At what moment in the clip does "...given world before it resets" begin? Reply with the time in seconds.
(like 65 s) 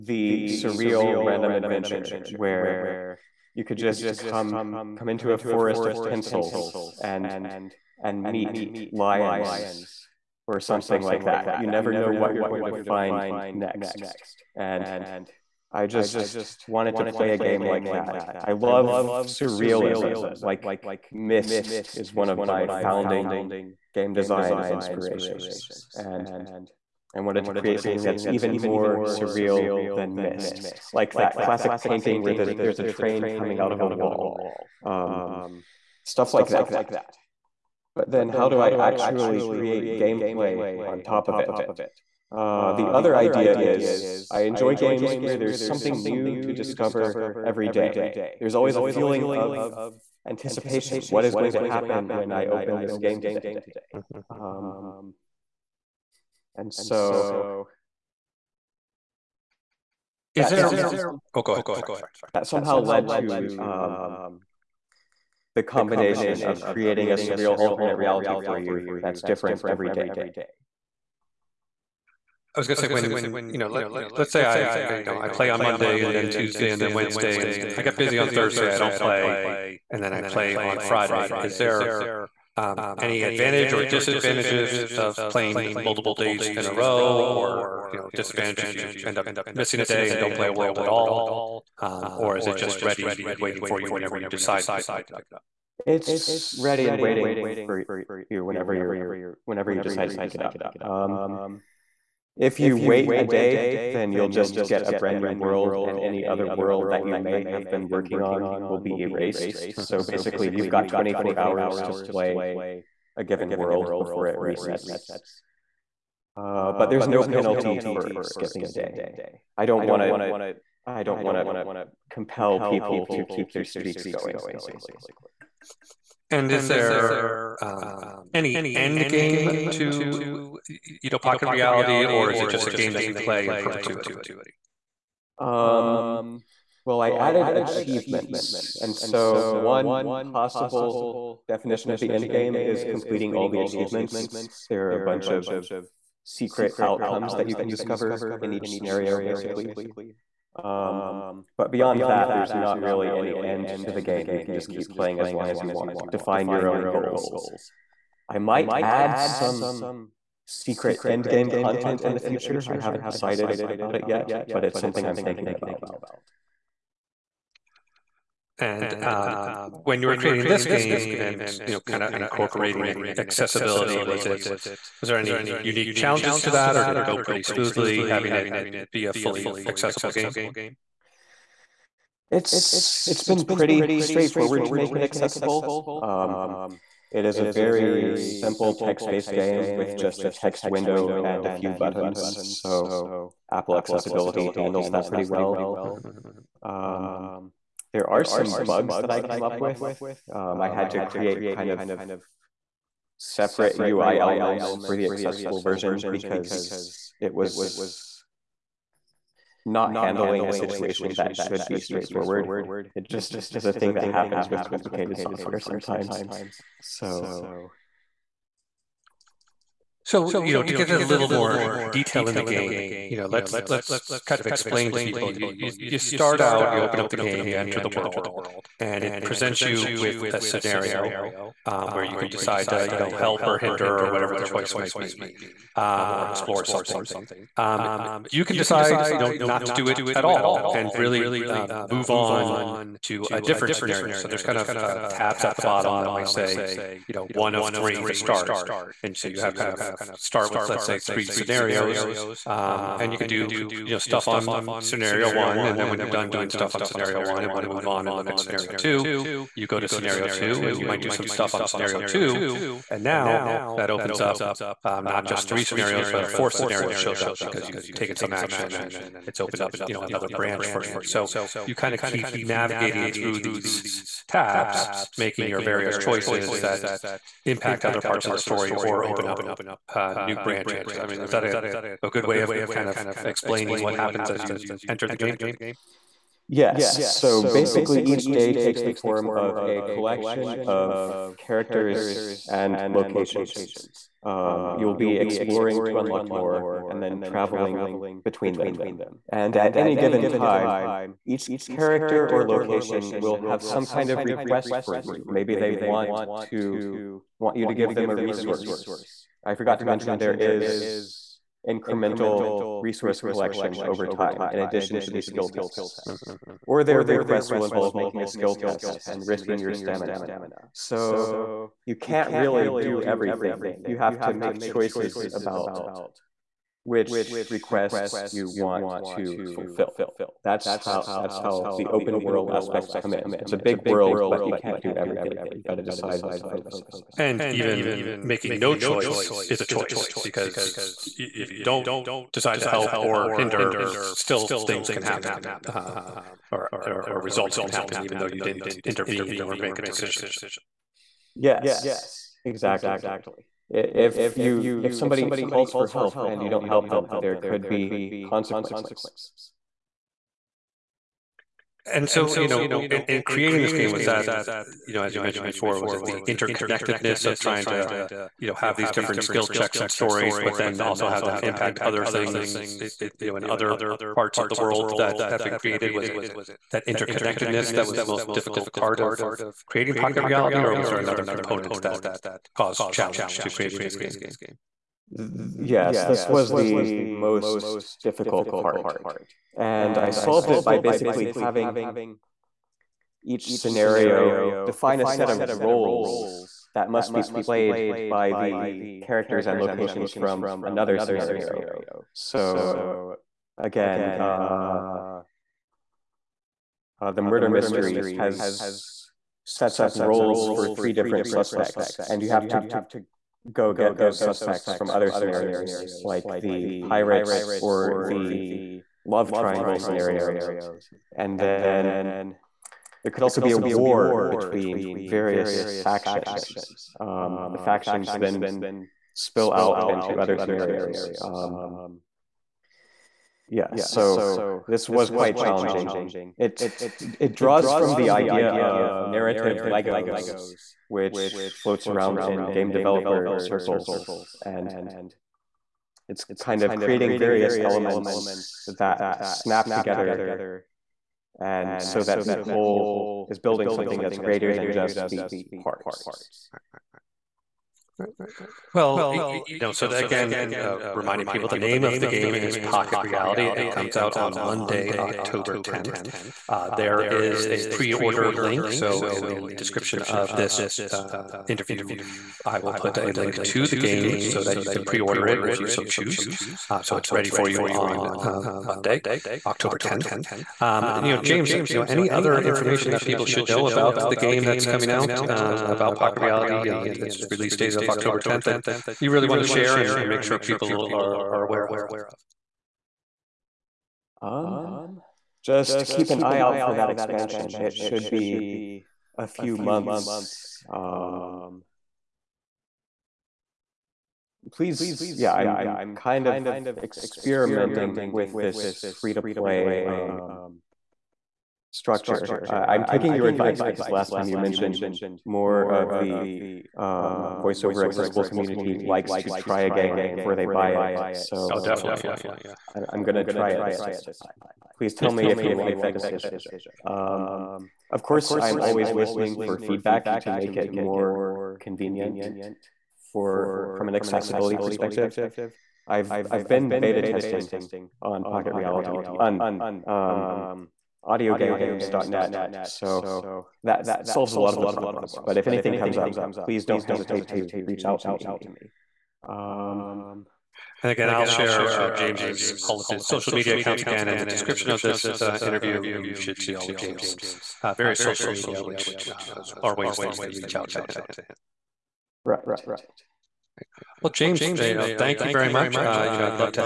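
113 s.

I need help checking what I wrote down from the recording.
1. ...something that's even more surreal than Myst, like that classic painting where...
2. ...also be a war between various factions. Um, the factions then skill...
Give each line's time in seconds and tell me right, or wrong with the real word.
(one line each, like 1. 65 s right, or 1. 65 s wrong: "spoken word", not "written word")
1. 27 s right
2. 423 s wrong: "spill", not "skill".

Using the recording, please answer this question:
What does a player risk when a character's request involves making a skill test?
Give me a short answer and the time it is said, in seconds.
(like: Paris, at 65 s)
Stamina, at 319 s.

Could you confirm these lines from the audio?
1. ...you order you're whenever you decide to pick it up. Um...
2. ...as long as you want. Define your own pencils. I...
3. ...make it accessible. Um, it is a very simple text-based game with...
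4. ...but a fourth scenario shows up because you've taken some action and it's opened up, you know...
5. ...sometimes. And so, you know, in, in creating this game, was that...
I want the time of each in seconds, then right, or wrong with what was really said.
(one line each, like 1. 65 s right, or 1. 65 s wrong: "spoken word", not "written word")
1. 98 s wrong: "whenever", not "order"
2. 155 s wrong: "goals", not "pencils"
3. 184 s right
4. 266 s right
5. 358 s wrong: "consequences", not "sometimes".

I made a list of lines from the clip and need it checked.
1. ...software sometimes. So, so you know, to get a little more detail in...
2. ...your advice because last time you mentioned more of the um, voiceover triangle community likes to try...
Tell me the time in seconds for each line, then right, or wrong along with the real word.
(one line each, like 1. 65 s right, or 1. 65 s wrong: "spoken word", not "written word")
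1. 215 s right
2. 513 s wrong: "accessible", not "triangle".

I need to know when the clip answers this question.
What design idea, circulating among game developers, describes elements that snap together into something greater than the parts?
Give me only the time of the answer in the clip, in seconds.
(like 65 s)
439 s.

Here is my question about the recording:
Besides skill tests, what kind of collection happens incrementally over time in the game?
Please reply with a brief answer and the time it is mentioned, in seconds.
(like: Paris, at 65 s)
Resource collection, at 312 s.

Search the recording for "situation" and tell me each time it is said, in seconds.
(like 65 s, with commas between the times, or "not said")
210 s.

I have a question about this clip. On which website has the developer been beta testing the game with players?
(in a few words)
audiogames.net.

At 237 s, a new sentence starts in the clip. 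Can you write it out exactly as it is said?
Um, you can decide, you know, not to do it at all and really um, move on to a different scenario.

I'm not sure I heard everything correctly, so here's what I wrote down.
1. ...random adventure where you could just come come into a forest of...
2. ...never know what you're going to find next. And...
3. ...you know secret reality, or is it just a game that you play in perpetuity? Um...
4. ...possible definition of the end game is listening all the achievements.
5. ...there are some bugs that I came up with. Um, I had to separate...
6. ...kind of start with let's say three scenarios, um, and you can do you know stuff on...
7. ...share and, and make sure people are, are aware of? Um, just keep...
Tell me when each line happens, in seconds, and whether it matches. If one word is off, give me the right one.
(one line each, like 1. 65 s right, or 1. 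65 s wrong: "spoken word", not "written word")
1. 1 s right
2. 11 s right
3. 130 s wrong: "pocket", not "secret"
4. 140 s wrong: "completing", not "listening"
5. 197 s wrong: "create", not "separate"
6. 249 s right
7. 489 s right.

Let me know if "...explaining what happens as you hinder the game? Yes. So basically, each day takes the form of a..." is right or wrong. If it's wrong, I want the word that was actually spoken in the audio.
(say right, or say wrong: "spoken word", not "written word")
wrong: "enter", not "hinder".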